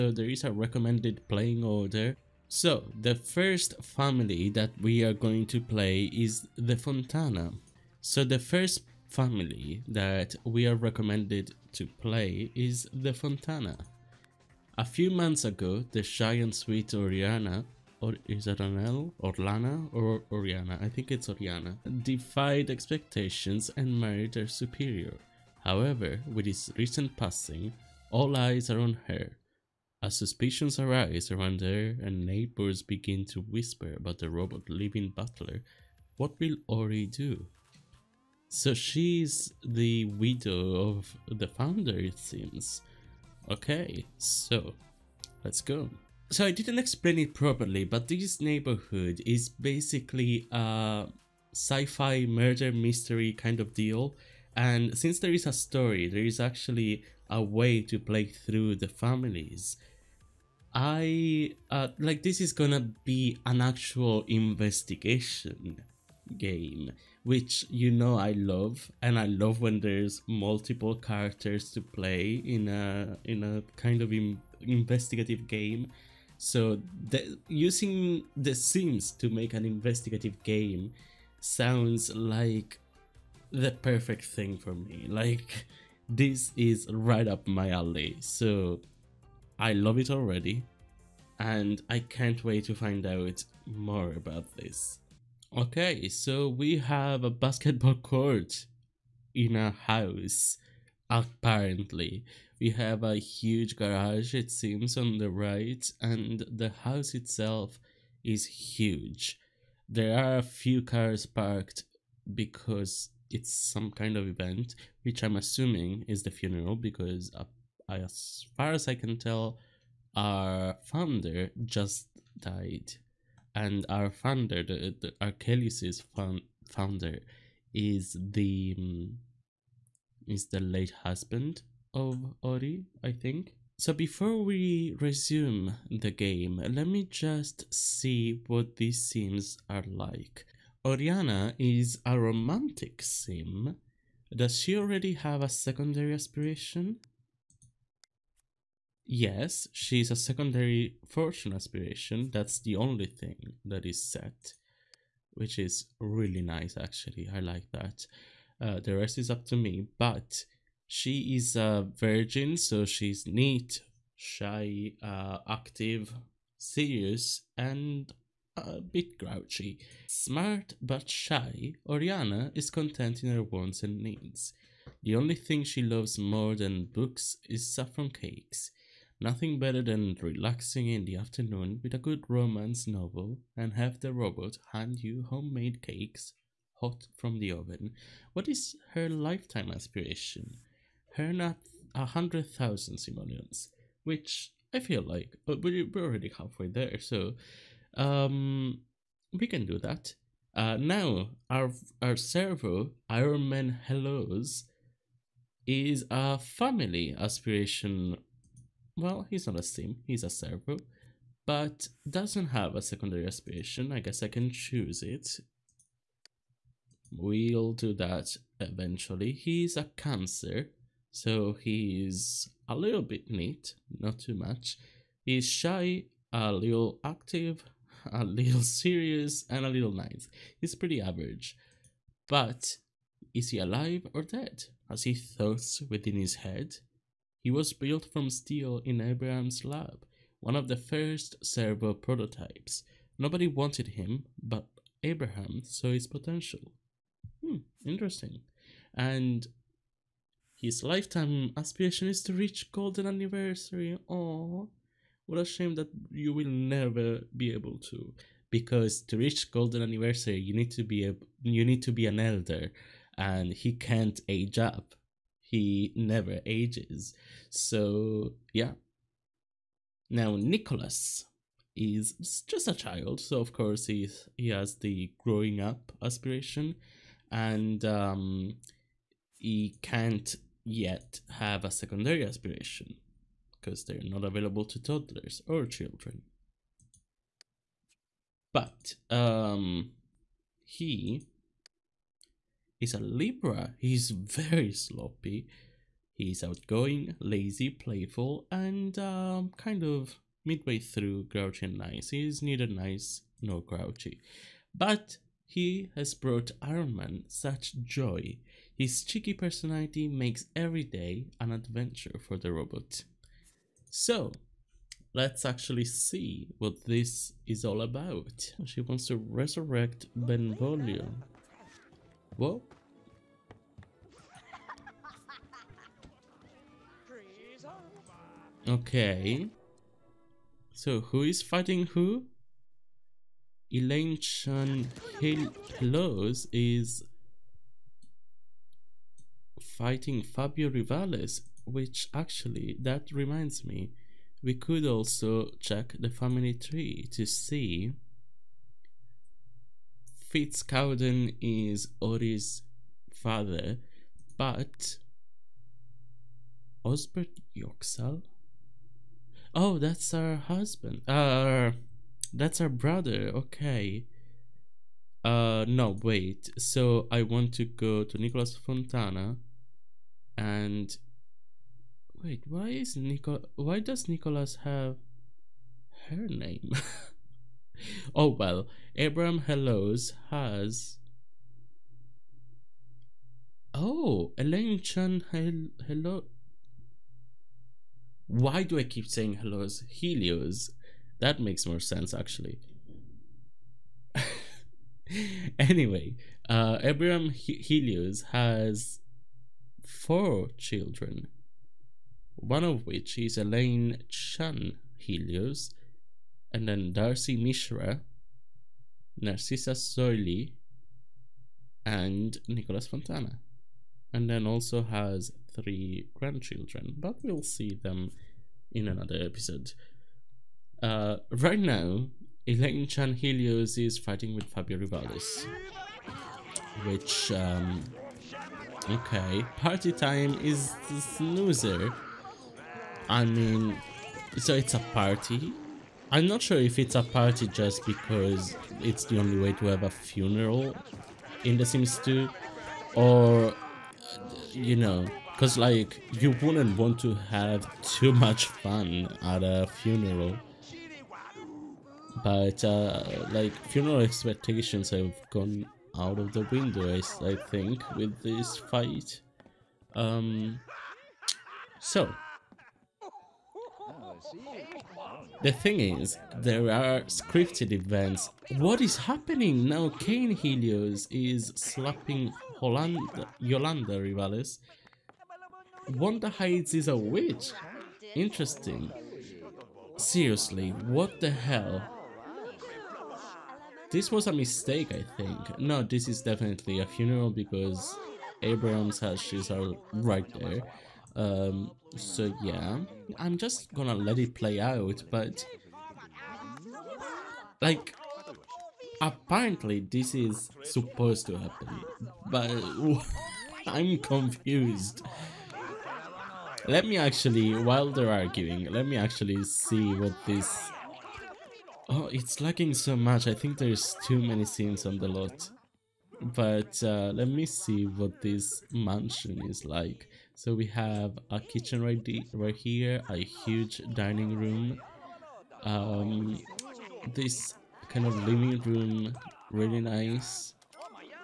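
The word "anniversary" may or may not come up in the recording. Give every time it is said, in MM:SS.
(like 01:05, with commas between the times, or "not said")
04:13, 04:19.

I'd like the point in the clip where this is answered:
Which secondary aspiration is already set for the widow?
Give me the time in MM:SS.
02:31.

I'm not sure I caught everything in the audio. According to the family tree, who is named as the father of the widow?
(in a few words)
Fitz Cowden.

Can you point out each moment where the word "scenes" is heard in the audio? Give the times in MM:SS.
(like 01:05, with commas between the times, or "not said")
02:19, 08:34.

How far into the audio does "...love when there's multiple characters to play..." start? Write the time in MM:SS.
01:09.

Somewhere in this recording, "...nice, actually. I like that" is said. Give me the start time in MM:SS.
02:36.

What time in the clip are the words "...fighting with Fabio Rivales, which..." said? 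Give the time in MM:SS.
07:03.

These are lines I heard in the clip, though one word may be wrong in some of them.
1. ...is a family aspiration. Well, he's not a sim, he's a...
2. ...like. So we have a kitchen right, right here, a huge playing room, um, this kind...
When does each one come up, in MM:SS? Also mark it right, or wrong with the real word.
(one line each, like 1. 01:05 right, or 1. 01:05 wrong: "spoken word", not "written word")
1. 03:25 right
2. 08:39 wrong: "dining", not "playing".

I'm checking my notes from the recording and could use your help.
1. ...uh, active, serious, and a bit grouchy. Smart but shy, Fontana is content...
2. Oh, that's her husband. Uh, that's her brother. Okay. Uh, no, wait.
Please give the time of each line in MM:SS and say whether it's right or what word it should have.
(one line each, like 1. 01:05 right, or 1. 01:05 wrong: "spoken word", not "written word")
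1. 02:45 wrong: "Oriana", not "Fontana"
2. 05:59 right.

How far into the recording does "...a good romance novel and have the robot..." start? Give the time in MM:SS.
03:01.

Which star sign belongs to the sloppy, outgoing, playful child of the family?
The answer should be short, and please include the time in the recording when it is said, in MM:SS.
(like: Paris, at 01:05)
Libra, at 04:52.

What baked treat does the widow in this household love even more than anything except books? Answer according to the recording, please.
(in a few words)
Saffron cakes.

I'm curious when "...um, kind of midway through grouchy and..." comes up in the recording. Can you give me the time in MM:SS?
04:58.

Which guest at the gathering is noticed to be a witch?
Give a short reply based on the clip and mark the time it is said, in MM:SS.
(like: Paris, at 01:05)
Wanda Heights, at 07:55.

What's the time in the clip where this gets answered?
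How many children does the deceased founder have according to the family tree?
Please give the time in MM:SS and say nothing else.
06:39.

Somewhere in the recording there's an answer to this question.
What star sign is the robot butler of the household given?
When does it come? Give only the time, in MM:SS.
03:39.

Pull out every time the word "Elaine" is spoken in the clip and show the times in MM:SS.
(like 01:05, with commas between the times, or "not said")
05:33, 06:24, 06:43, 07:02.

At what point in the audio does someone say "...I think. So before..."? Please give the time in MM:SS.
02:13.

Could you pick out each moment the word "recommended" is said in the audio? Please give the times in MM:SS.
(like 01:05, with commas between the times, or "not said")
00:00, 00:10.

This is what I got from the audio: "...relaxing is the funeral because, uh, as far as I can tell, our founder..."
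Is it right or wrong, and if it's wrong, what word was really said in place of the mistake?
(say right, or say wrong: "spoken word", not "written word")
wrong: "assuming", not "relaxing".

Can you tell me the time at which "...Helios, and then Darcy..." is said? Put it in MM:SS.
06:44.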